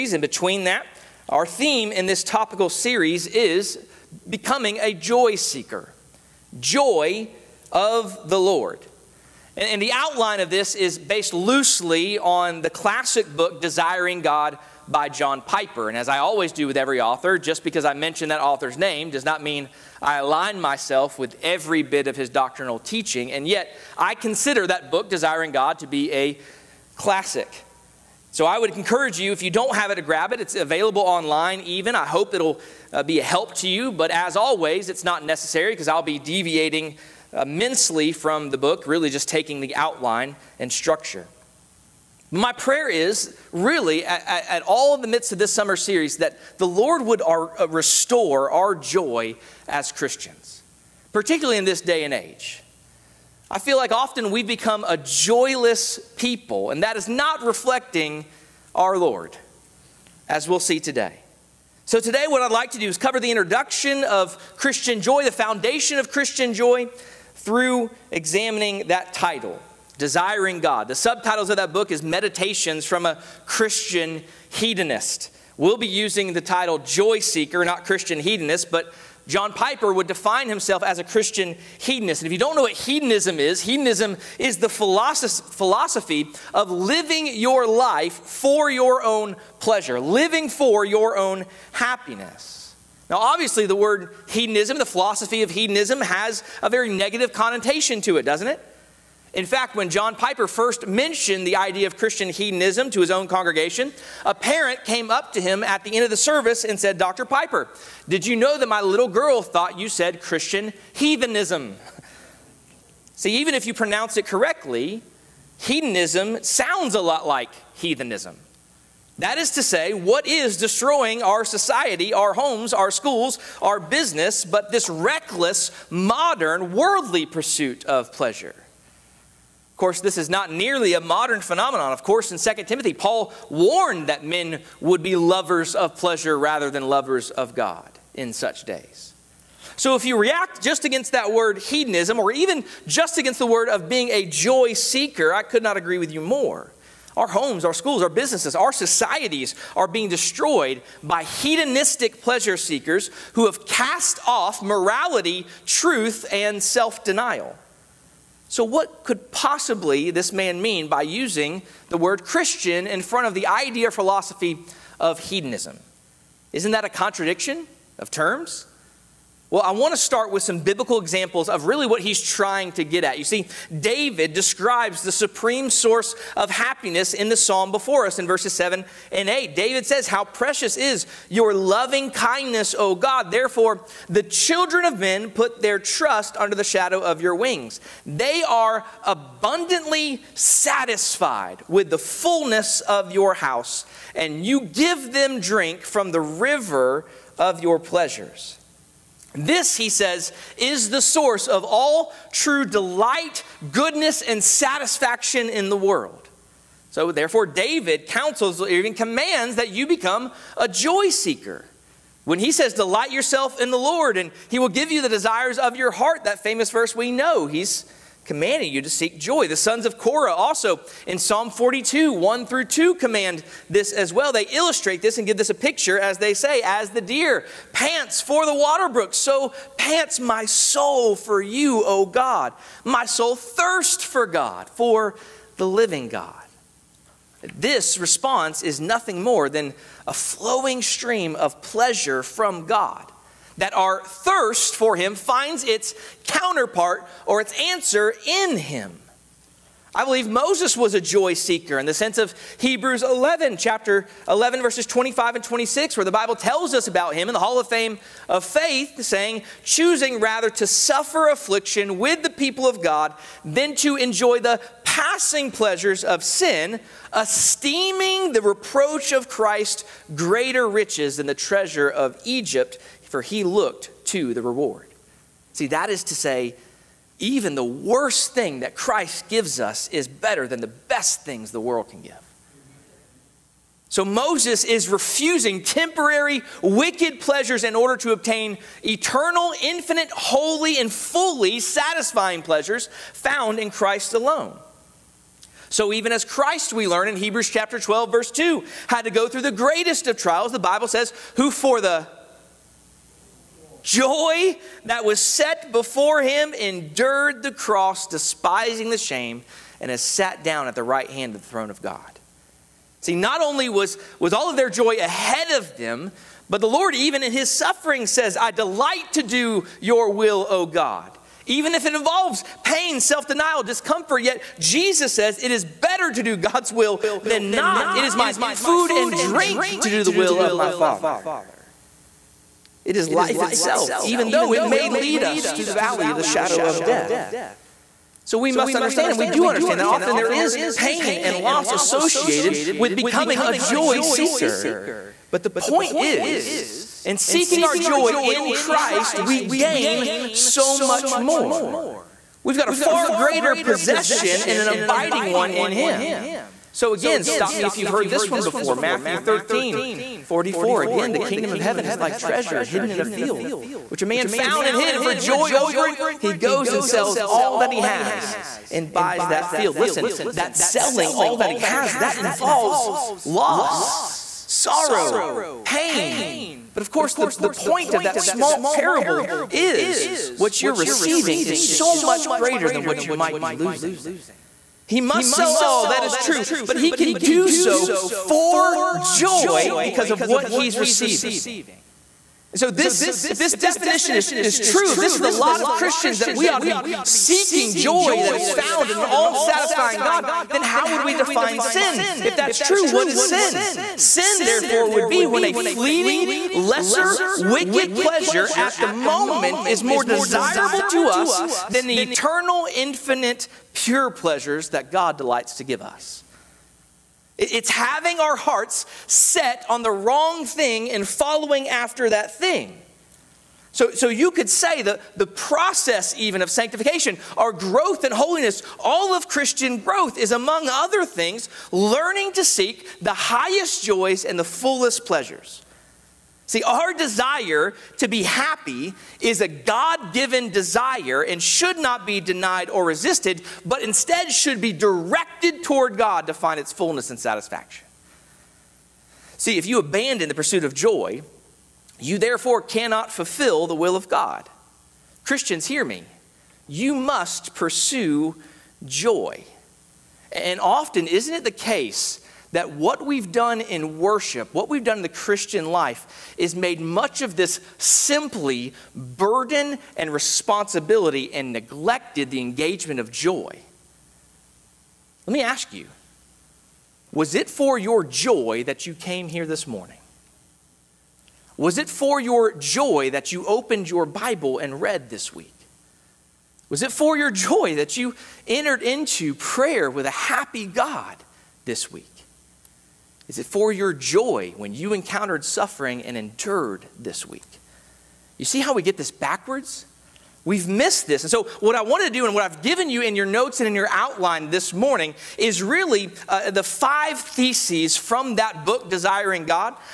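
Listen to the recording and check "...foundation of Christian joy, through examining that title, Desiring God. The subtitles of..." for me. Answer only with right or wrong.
right.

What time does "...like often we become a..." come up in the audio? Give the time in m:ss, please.
0:53.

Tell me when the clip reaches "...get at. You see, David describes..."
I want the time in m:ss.
2:52.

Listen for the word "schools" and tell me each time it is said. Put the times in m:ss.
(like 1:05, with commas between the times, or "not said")
2:02, 2:27.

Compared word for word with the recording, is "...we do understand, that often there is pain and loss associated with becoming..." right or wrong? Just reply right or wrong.
right.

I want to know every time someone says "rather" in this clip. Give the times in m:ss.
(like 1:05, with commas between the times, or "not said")
2:16, 4:20.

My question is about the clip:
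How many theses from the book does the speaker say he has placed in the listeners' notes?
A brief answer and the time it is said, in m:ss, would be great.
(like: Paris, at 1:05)
5, at 8:26.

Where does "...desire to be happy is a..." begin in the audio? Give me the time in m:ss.
7:16.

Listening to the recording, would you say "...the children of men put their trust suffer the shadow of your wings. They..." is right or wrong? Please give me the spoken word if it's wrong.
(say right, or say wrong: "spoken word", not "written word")
wrong: "under", not "suffer".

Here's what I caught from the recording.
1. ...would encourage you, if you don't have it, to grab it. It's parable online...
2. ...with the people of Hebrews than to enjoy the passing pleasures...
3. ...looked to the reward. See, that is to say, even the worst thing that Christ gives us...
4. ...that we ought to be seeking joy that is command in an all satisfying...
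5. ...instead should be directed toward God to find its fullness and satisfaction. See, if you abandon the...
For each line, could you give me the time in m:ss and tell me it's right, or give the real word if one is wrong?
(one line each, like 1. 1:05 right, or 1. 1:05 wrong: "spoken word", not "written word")
1. 0:28 wrong: "available", not "parable"
2. 4:21 wrong: "God", not "Hebrews"
3. 4:33 right
4. 6:36 wrong: "found", not "command"
5. 7:23 right.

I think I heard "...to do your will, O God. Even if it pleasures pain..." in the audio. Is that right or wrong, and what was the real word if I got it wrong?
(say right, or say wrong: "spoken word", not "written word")
wrong: "involves", not "pleasures".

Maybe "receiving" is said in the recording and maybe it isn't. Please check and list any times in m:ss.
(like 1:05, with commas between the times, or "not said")
6:20, 6:30.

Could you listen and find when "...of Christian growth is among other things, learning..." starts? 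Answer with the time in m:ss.
7:09.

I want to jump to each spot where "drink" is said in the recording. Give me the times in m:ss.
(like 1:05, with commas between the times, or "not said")
3:15, 5:29.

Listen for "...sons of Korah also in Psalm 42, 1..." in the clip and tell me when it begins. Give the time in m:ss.
3:39.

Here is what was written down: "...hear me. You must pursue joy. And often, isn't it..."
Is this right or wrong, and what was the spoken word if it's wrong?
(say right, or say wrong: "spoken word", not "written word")
right.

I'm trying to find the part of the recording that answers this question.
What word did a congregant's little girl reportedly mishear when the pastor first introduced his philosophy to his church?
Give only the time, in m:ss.
1:50.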